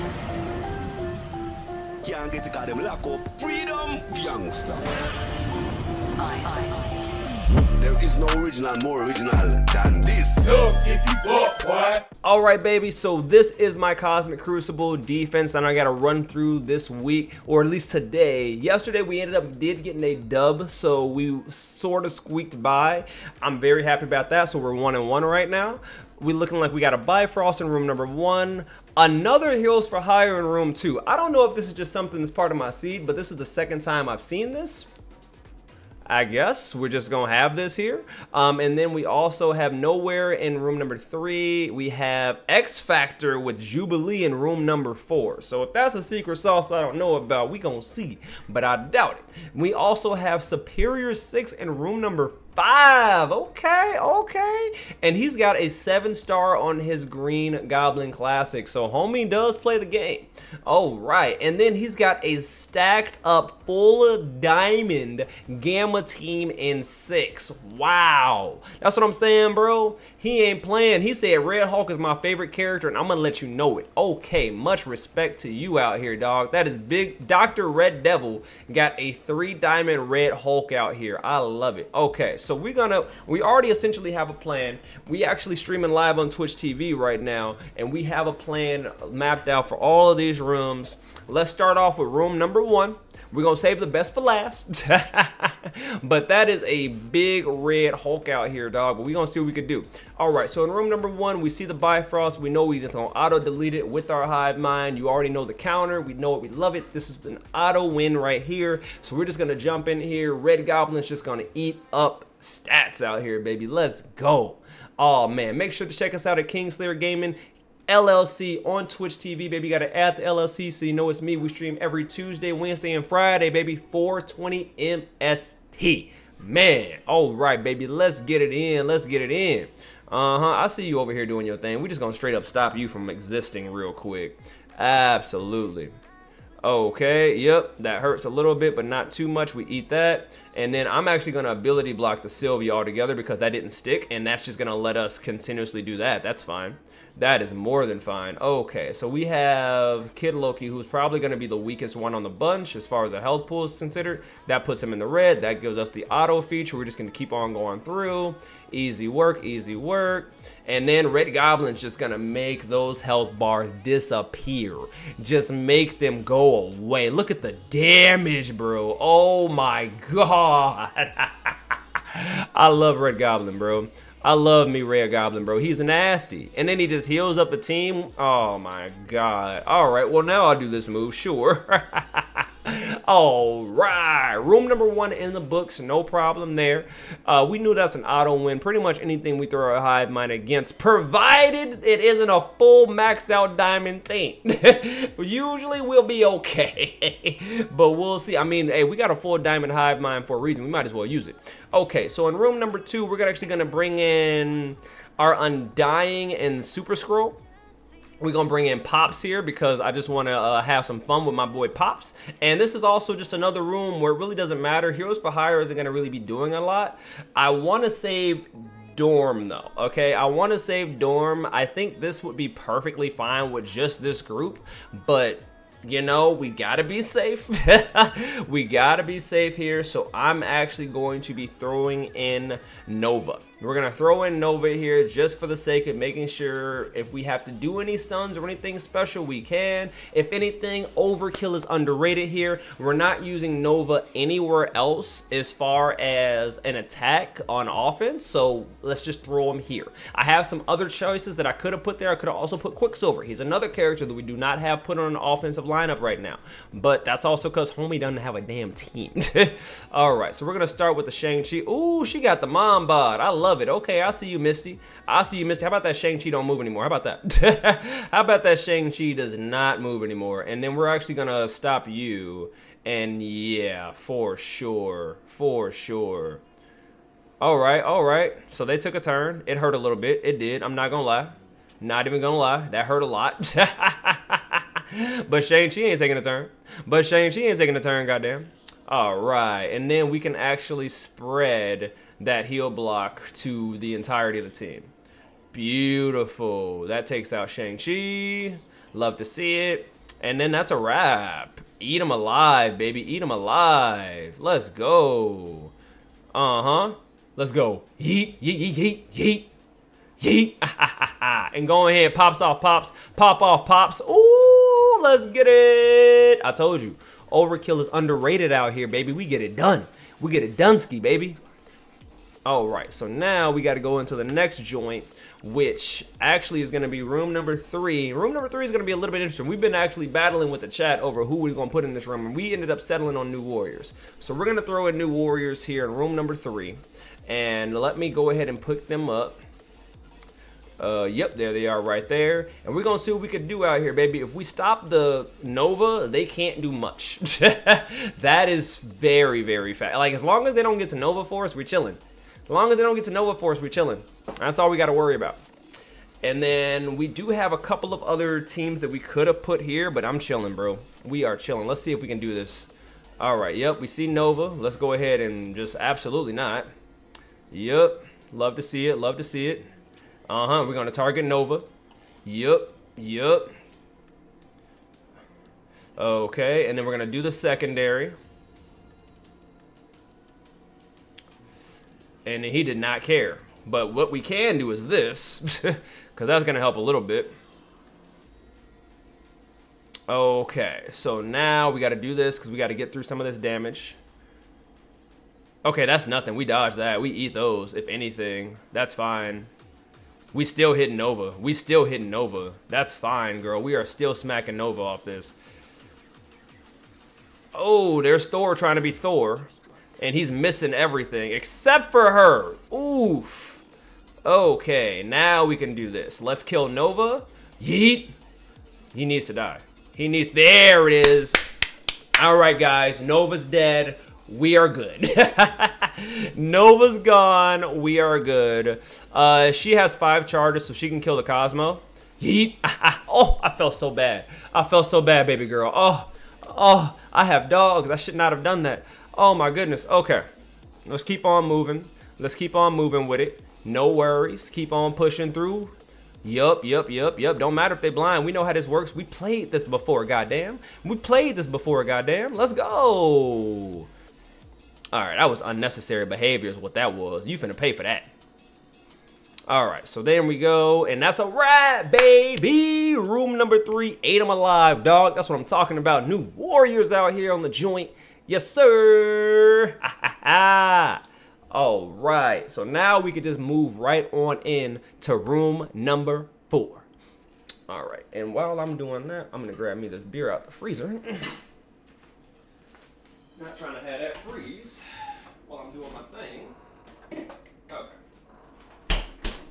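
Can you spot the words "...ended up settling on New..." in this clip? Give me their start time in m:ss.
5:32.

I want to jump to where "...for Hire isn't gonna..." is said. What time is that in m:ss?
3:35.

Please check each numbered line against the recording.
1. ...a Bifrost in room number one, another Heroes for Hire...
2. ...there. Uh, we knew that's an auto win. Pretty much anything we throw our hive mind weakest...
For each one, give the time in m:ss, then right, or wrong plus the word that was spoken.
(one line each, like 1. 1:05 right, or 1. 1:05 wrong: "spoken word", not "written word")
1. 0:26 right
2. 3:06 wrong: "against", not "weakest".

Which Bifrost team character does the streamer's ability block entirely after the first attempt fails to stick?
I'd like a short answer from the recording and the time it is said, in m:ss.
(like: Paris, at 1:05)
Sylvie, at 2:22.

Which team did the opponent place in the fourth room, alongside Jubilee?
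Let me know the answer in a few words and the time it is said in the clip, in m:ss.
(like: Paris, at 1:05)
X Factor, at 0:42.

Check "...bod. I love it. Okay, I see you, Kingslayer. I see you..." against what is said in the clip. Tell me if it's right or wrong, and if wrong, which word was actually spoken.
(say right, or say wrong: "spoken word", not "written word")
wrong: "Misty", not "Kingslayer".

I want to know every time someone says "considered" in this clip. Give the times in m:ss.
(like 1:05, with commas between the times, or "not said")
2:33.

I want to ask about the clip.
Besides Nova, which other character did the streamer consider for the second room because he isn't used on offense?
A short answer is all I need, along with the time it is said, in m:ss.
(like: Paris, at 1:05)
Quicksilver, at 4:12.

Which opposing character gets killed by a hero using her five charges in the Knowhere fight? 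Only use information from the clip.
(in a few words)
Cosmo.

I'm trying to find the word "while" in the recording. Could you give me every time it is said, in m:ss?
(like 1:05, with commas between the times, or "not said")
7:58, 8:05.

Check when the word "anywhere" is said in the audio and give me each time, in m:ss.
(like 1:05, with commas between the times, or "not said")
4:04.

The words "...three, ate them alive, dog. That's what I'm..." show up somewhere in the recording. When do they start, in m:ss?
7:43.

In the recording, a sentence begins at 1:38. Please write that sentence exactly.
But we gonna see what we could do.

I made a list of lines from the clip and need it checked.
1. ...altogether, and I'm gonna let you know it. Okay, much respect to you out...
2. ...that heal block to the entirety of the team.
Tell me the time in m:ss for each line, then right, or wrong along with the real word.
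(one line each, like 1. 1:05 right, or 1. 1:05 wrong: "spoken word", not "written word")
1. 1:12 wrong: "character", not "altogether"
2. 4:52 right.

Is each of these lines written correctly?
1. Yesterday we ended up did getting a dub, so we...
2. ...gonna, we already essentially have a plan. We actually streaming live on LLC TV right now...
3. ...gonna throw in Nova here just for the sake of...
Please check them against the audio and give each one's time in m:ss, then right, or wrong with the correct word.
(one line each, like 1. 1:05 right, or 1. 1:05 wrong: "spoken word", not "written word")
1. 0:18 right
2. 1:22 wrong: "Twitch", not "LLC"
3. 3:53 right.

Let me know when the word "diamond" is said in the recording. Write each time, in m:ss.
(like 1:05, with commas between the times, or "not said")
1:04, 1:19, 3:13, 3:19.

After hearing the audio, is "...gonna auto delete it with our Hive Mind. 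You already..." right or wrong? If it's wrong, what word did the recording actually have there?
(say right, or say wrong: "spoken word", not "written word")
right.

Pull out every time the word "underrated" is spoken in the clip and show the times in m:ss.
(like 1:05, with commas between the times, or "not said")
4:01, 5:17.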